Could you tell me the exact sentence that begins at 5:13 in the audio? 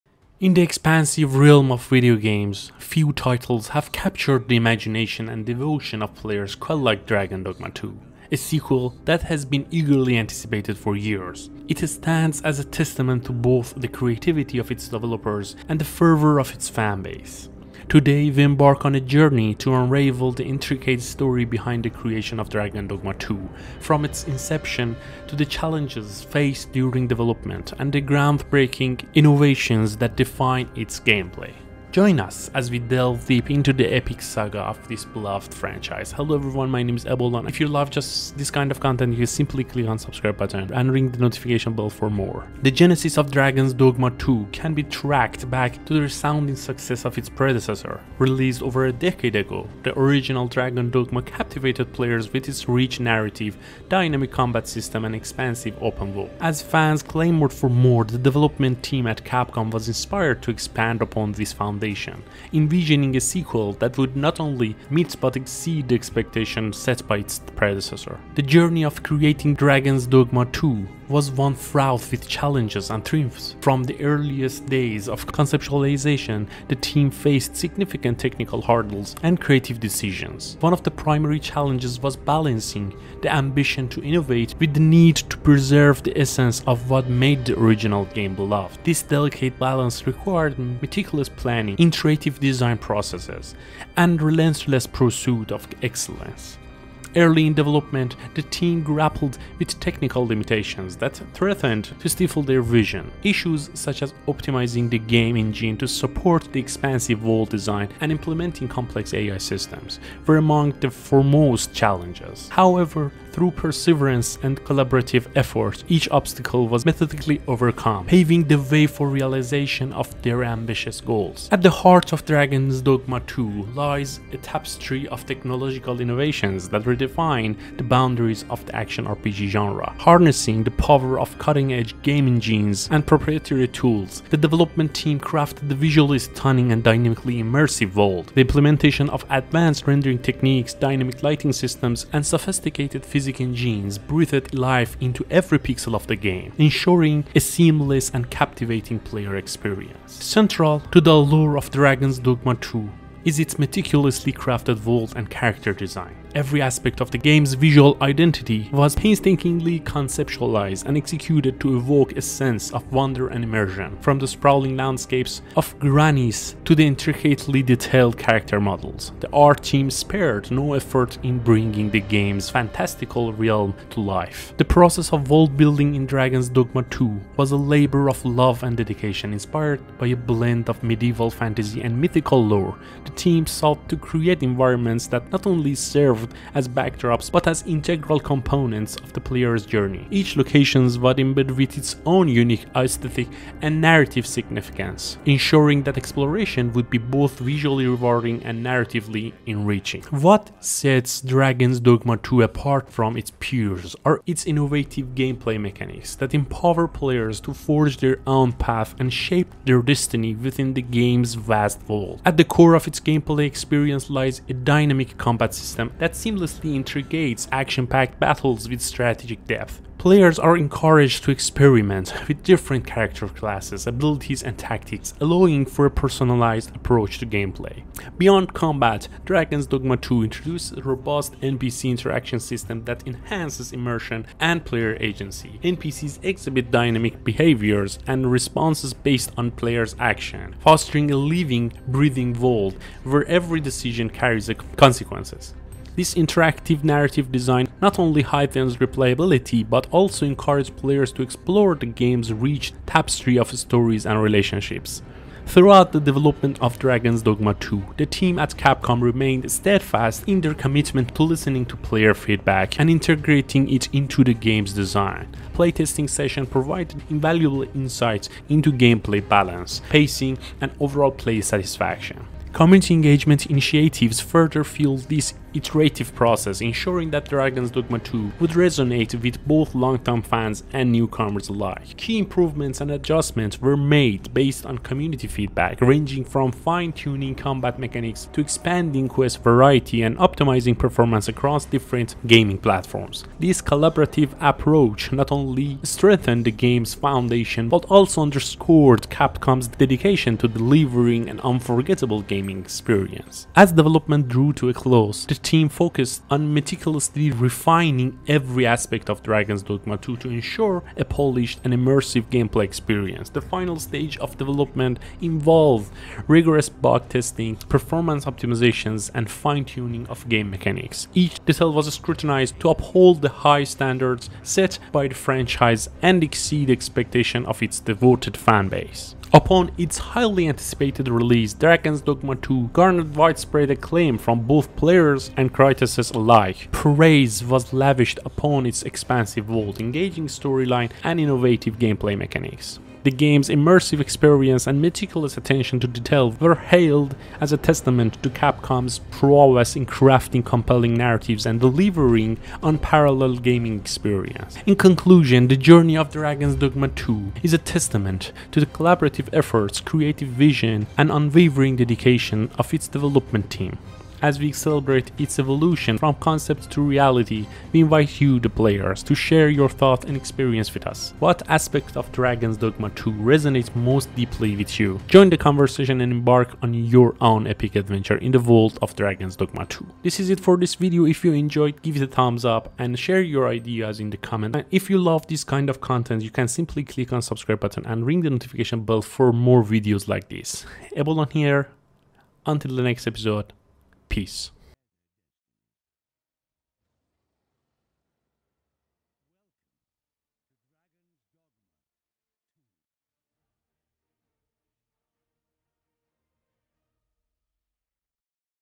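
The final stage of development involved rigorous bug testing, performance optimizations, and fine-tuning of game mechanics.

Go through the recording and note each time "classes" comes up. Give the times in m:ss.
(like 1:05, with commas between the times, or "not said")
3:43.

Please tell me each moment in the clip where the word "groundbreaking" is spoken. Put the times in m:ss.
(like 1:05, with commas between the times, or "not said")
0:28.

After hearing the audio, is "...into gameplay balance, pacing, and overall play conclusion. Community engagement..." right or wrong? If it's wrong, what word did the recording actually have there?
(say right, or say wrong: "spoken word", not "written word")
wrong: "satisfaction", not "conclusion".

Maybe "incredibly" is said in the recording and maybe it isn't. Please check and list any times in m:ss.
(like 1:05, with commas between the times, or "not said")
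not said.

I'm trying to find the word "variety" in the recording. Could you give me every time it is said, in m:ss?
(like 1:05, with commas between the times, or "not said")
4:49.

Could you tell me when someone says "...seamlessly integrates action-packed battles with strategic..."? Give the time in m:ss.
3:36.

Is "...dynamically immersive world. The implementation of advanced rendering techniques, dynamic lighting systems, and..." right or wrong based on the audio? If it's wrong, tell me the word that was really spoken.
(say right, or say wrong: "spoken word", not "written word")
right.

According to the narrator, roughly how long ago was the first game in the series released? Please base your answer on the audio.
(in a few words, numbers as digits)
Over a decade ago.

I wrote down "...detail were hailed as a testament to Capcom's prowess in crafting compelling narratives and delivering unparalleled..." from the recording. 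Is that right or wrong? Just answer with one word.
right.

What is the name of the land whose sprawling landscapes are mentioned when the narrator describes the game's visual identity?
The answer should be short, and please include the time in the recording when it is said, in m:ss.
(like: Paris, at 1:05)
Gransys, at 2:45.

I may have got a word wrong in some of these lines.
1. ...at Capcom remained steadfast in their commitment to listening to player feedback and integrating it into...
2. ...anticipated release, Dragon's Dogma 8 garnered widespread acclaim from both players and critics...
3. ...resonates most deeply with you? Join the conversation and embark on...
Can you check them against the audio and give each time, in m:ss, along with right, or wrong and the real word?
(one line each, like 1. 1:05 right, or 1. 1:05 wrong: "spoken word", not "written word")
1. 4:18 right
2. 5:30 wrong: "2", not "8"
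3. 6:13 right.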